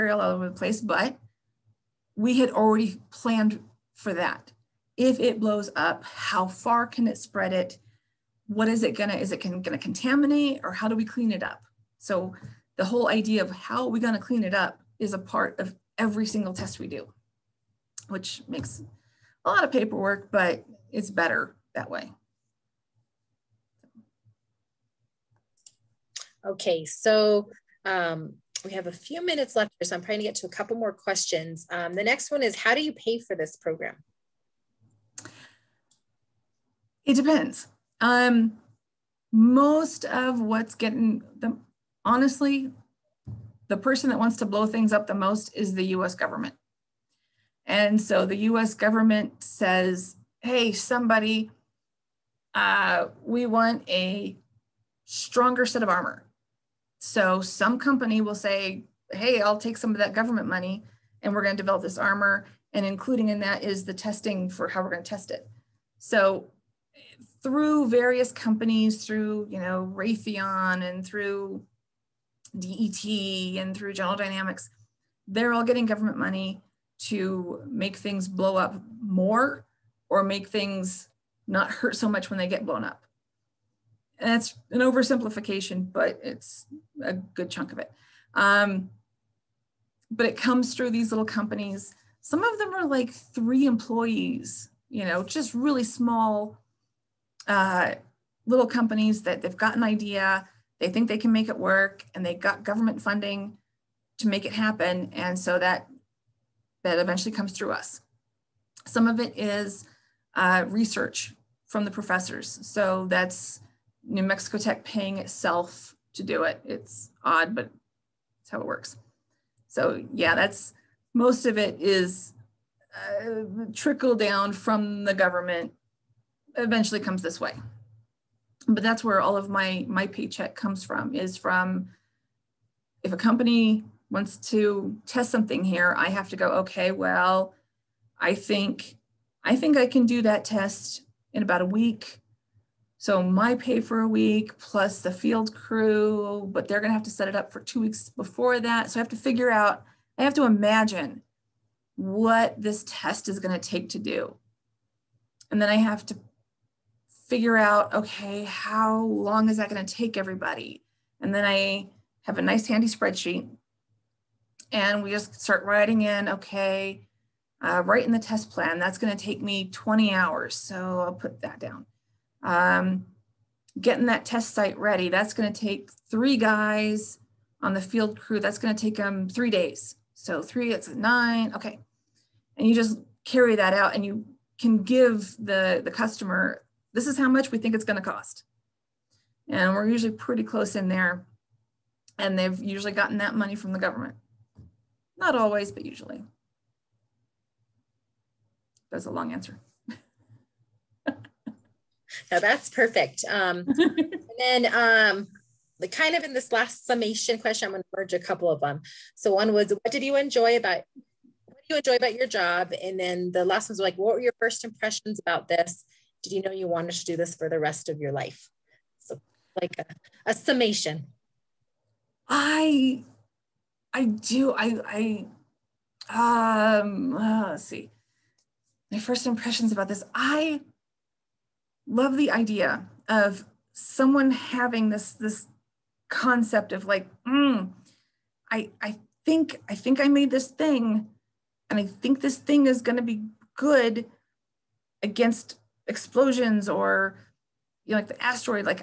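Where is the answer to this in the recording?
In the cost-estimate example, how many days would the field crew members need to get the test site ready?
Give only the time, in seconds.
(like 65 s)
179 s.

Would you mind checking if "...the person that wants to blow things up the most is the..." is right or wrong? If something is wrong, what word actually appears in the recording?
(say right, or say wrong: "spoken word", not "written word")
right.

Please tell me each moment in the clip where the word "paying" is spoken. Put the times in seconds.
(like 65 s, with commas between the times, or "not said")
114 s.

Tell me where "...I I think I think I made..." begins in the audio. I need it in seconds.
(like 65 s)
238 s.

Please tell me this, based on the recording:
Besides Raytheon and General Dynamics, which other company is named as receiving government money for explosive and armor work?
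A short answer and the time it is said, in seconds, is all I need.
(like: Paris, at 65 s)
DET, at 72 s.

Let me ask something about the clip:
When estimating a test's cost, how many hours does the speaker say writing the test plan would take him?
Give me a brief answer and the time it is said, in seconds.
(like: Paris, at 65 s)
20 hours, at 169 s.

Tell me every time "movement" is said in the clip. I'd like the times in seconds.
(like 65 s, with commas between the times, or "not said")
not said.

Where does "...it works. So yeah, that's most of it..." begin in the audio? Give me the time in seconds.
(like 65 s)
118 s.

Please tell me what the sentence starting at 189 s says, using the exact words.
And we're usually pretty close in there.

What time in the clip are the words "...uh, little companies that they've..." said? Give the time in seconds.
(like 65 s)
97 s.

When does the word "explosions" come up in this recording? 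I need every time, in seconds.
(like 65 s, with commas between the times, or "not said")
245 s.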